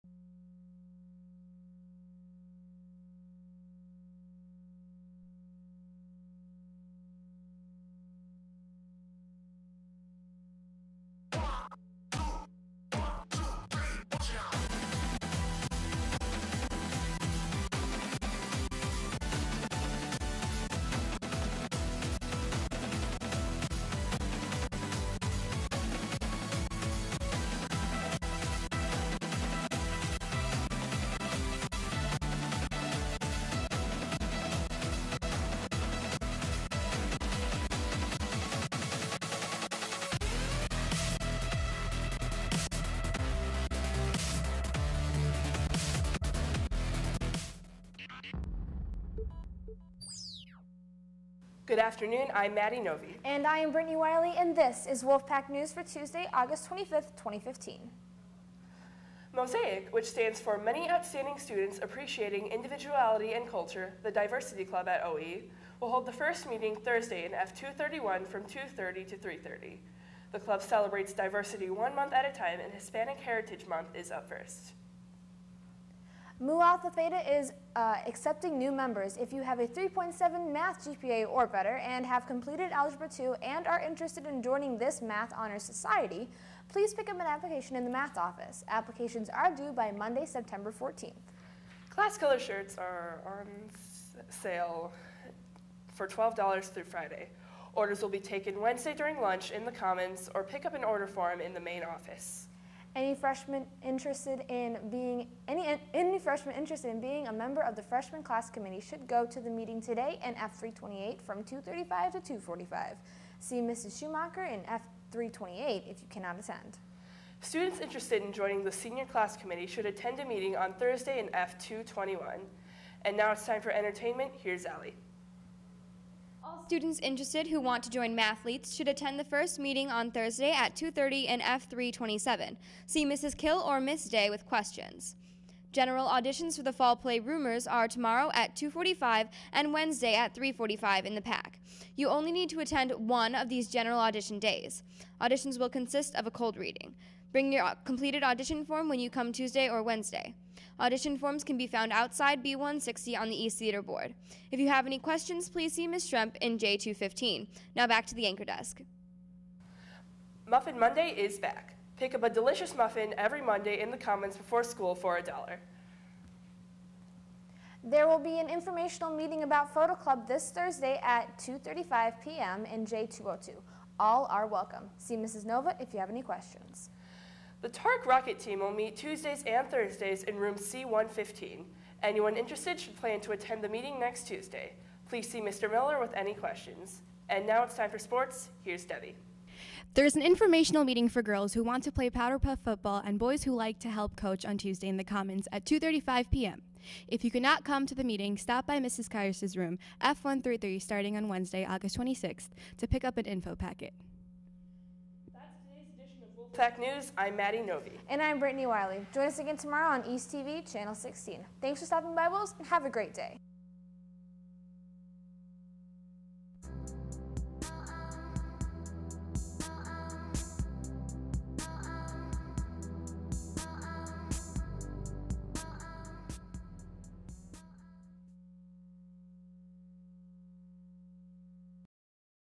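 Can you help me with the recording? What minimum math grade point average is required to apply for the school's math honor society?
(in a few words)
3.7.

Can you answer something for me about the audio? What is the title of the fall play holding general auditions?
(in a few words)
Rumors.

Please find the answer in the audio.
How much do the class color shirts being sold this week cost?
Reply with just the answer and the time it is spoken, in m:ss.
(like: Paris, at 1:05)
$12, at 1:36.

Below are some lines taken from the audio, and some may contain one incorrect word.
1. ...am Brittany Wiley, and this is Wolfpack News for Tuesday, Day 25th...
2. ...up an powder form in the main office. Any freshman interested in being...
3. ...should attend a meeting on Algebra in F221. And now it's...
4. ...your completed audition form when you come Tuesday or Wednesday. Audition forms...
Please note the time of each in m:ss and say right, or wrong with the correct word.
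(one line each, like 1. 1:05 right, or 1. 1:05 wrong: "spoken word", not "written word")
1. 0:53 wrong: "August", not "Day"
2. 1:40 wrong: "order", not "powder"
3. 1:59 wrong: "Thursday", not "Algebra"
4. 2:27 right.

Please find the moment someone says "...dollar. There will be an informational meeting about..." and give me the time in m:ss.
2:45.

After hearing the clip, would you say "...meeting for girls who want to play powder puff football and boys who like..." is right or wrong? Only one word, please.
right.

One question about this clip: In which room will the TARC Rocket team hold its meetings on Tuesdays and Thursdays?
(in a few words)
C115.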